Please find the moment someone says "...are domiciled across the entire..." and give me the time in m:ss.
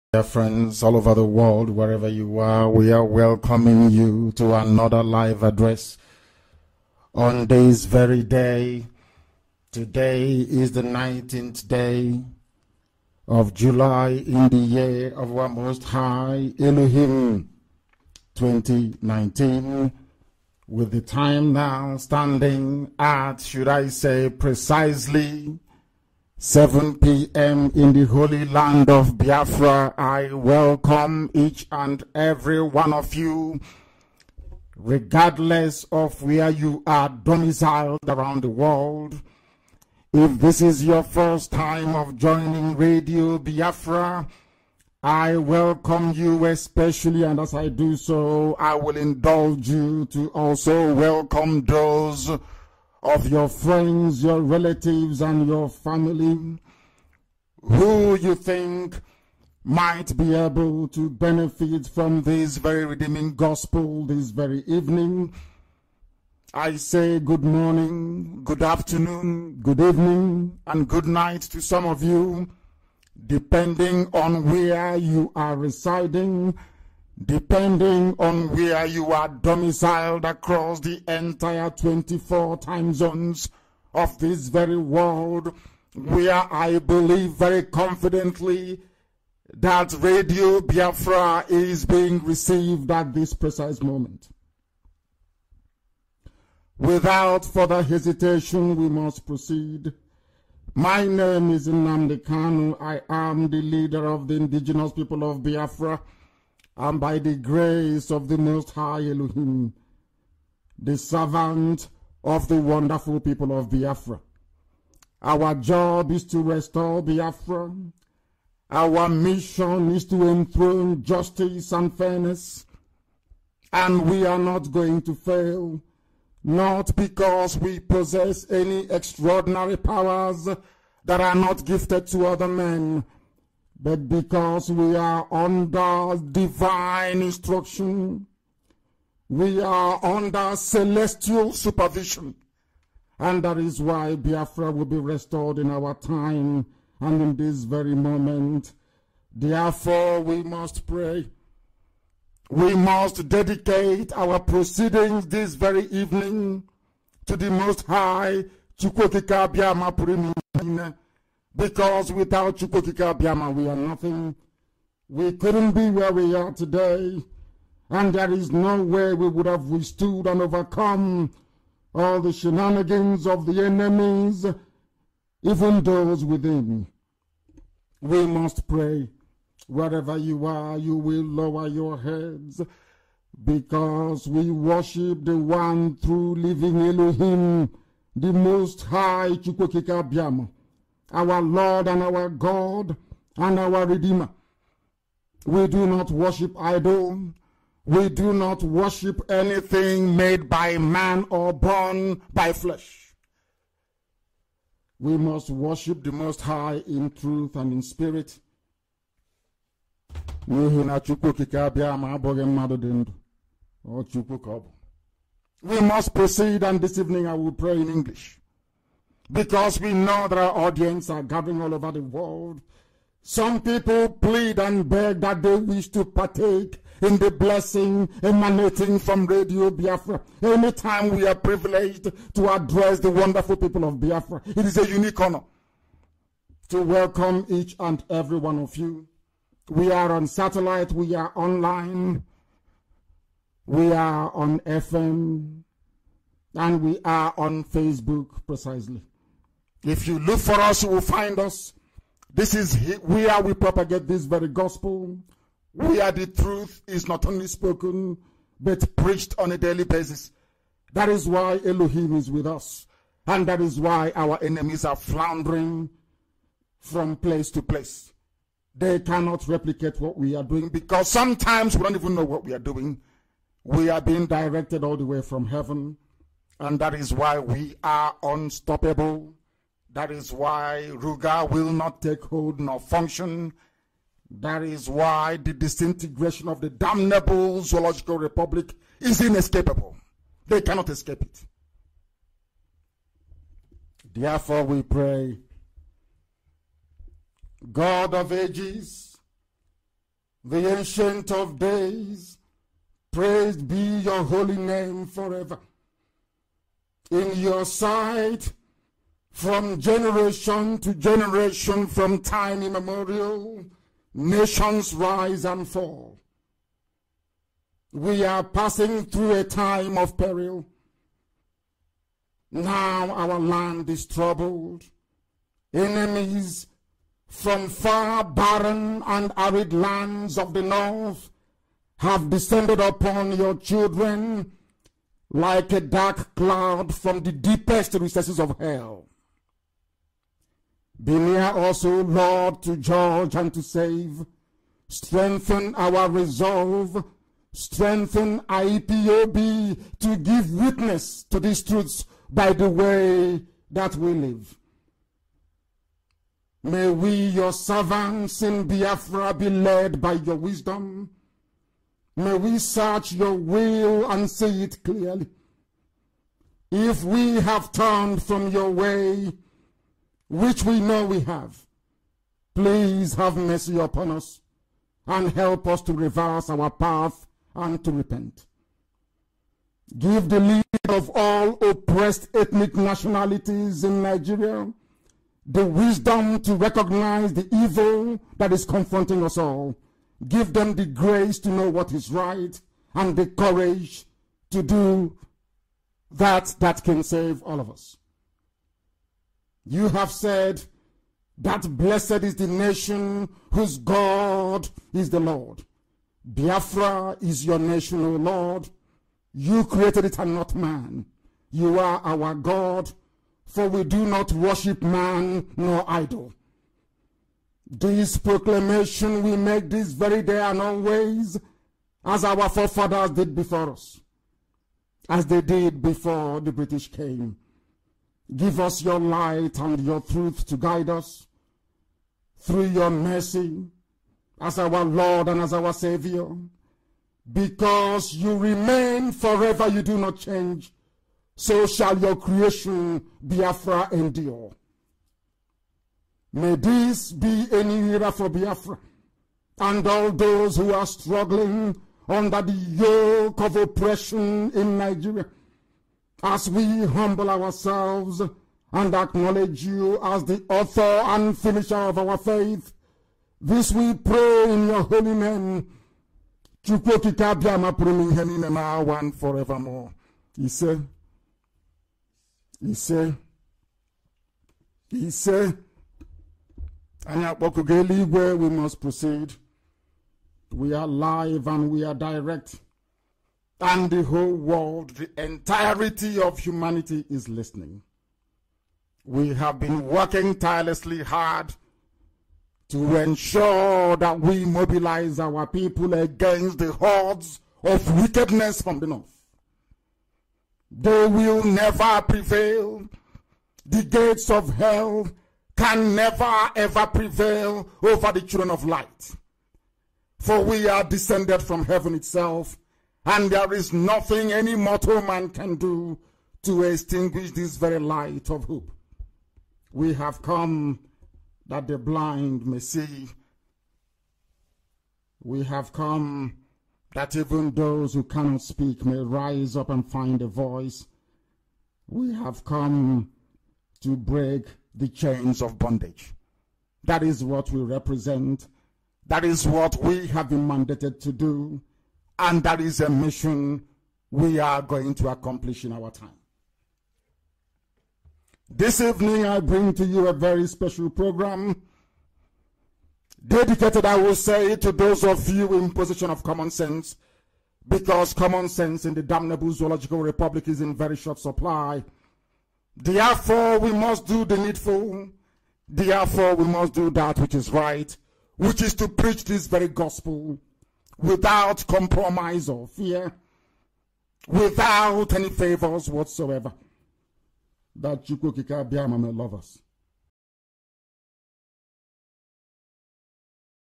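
1:19.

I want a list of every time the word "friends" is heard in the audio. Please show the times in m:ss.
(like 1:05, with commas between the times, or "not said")
0:00, 0:53.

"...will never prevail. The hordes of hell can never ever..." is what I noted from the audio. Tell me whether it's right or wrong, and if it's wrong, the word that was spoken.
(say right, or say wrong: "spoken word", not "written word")
wrong: "gates", not "hordes".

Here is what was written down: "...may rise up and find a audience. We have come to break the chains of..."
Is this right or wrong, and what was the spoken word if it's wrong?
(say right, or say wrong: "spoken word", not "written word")
wrong: "voice", not "audience".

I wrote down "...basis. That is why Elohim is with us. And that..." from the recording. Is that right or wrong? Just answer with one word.
right.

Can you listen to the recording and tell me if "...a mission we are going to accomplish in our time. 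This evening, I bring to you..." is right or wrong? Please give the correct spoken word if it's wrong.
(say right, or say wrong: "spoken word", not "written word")
right.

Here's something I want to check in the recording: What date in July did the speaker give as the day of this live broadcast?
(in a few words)
19th.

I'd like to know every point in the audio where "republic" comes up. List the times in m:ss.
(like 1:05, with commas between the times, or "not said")
4:48, 9:19.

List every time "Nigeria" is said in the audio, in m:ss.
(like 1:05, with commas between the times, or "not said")
6:24, 7:34.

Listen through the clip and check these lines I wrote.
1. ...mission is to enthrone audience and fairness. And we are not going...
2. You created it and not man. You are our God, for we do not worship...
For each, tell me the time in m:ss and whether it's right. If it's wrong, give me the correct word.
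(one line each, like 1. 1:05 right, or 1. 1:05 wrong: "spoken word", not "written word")
1. 1:59 wrong: "justice", not "audience"
2. 6:49 right.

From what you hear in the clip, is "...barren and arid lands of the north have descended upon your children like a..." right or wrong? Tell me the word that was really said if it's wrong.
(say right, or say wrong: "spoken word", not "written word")
right.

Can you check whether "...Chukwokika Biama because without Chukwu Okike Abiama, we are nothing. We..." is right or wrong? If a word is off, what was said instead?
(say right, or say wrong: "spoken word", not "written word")
right.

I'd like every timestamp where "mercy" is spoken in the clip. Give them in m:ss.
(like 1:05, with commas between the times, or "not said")
6:13, 7:12.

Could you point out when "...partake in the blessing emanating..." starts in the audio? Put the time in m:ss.
3:46.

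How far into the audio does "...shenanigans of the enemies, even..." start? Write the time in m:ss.
2:52.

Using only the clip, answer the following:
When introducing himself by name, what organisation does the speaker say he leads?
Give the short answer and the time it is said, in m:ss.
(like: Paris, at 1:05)
the indigenous people of Biafra, at 1:44.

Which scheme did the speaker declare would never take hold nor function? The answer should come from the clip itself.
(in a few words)
Ruga.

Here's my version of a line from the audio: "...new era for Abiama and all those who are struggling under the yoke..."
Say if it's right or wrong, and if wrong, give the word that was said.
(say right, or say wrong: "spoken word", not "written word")
wrong: "Biafra", not "Abiama".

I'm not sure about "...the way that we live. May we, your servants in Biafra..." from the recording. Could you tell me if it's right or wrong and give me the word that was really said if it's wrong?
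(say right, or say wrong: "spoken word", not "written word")
right.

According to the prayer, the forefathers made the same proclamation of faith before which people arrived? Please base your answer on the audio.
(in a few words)
the British.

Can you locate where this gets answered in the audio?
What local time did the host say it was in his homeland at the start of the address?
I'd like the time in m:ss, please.
0:26.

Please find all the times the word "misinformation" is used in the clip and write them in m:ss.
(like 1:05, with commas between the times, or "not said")
not said.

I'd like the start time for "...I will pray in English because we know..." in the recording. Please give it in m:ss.
3:37.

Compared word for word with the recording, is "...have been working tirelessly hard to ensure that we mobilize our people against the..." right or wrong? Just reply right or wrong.
right.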